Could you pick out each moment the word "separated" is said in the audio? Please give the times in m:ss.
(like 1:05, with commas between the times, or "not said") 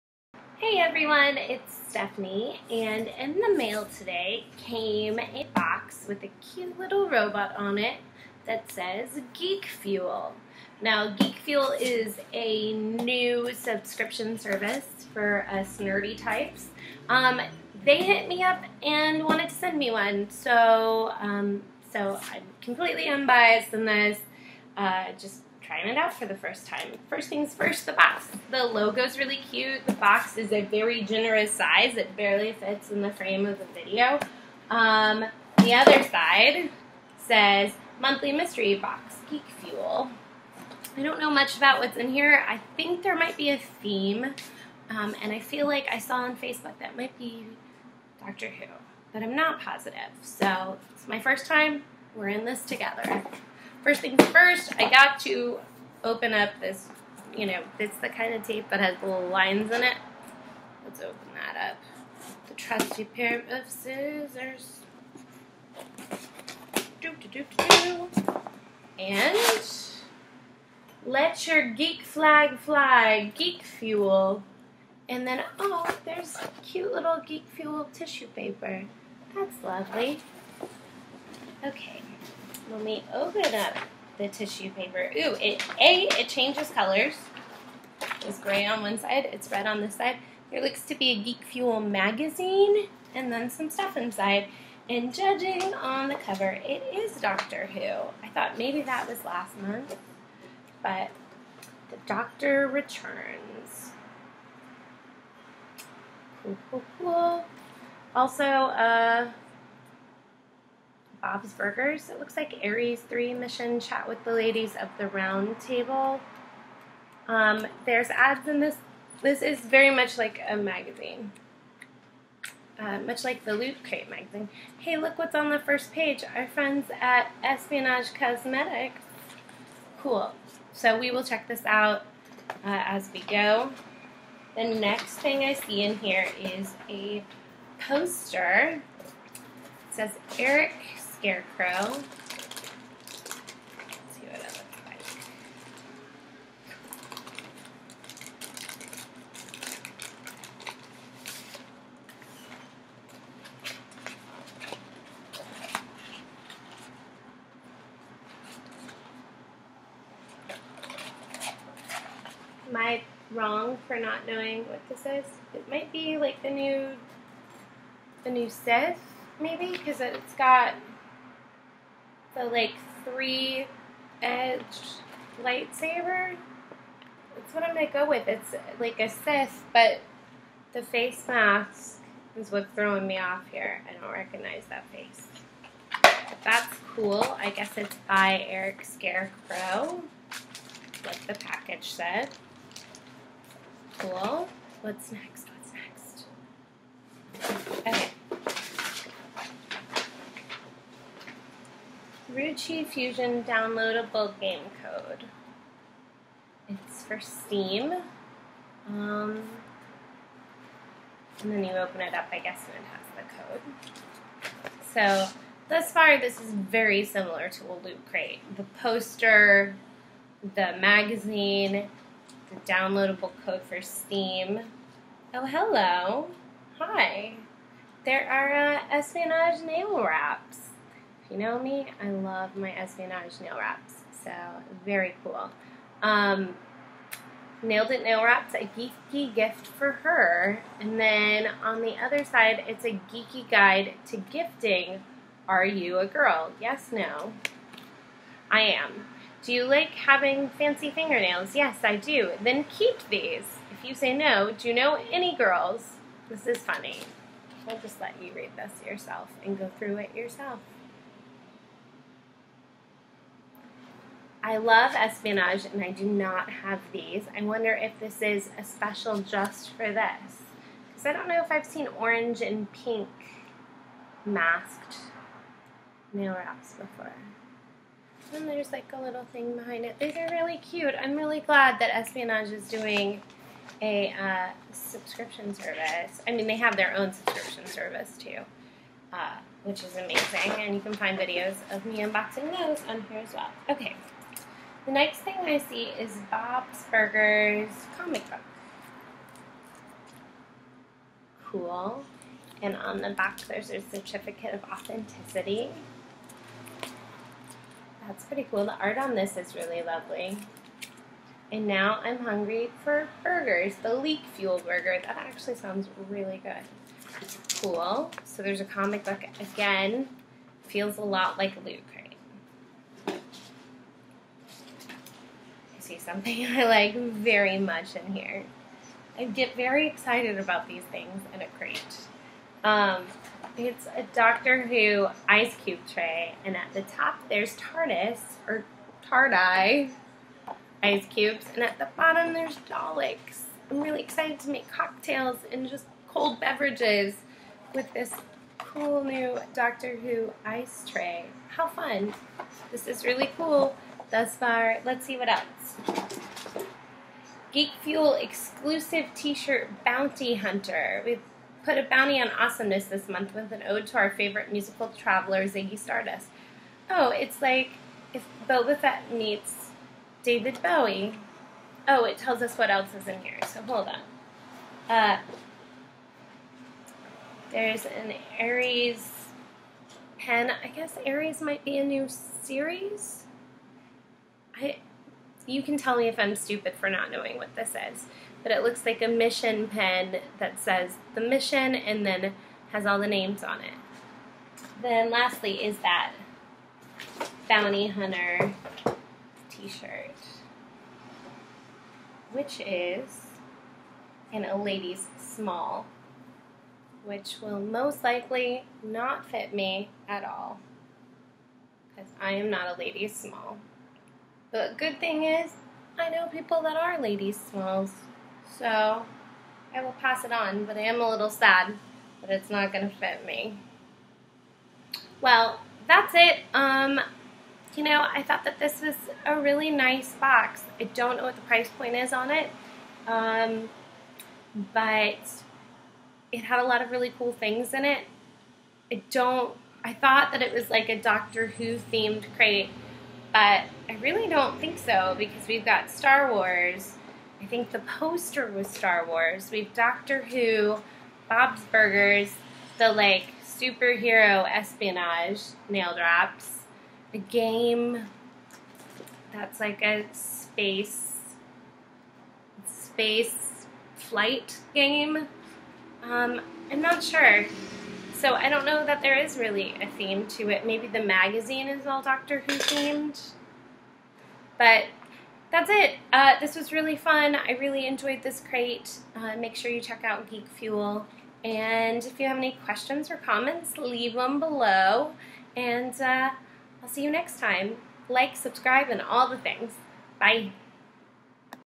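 not said.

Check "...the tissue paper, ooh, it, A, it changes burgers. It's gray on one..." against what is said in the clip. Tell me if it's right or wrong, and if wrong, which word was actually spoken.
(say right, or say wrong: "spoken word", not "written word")
wrong: "colors", not "burgers".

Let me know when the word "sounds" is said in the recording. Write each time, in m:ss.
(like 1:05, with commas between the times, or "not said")
5:15.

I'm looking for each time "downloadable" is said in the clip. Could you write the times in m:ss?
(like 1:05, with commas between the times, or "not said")
3:23, 3:42.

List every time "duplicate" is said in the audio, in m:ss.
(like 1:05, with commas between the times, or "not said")
not said.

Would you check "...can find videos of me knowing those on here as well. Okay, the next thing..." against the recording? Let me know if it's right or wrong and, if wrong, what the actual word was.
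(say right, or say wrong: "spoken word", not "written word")
wrong: "unboxing", not "knowing".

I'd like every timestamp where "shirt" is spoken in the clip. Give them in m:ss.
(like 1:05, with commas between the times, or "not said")
5:59, 6:39.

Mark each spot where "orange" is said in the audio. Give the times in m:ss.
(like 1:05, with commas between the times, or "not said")
4:31.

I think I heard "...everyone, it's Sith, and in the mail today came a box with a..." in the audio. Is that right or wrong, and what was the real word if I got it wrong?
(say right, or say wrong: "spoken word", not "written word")
wrong: "Stephanie", not "Sith".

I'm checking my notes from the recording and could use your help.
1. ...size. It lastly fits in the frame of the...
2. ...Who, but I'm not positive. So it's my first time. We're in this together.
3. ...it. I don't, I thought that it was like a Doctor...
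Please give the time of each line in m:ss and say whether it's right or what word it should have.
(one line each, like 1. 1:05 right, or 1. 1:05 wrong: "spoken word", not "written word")
1. 0:31 wrong: "barely", not "lastly"
2. 0:48 right
3. 7:17 right.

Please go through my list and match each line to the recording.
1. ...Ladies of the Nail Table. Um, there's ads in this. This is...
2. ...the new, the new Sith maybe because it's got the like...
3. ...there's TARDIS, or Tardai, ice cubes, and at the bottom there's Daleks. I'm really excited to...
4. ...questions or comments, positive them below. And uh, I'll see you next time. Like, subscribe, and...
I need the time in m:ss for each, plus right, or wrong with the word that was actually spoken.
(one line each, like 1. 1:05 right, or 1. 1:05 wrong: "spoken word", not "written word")
1. 1:54 wrong: "Round", not "Nail"
2. 2:46 right
3. 5:37 right
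4. 8:02 wrong: "leave", not "positive".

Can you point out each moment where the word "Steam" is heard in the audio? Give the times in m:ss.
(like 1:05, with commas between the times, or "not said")
3:27, 3:43.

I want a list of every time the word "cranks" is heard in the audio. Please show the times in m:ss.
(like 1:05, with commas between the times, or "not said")
not said.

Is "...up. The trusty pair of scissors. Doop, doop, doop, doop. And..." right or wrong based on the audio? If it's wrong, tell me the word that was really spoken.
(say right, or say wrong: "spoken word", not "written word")
right.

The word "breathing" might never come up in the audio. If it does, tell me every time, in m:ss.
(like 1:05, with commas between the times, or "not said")
not said.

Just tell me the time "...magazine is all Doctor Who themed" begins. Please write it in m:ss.
7:51.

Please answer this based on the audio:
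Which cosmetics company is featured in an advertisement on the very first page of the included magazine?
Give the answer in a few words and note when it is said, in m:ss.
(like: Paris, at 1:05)
Espionage Cosmetics, at 2:07.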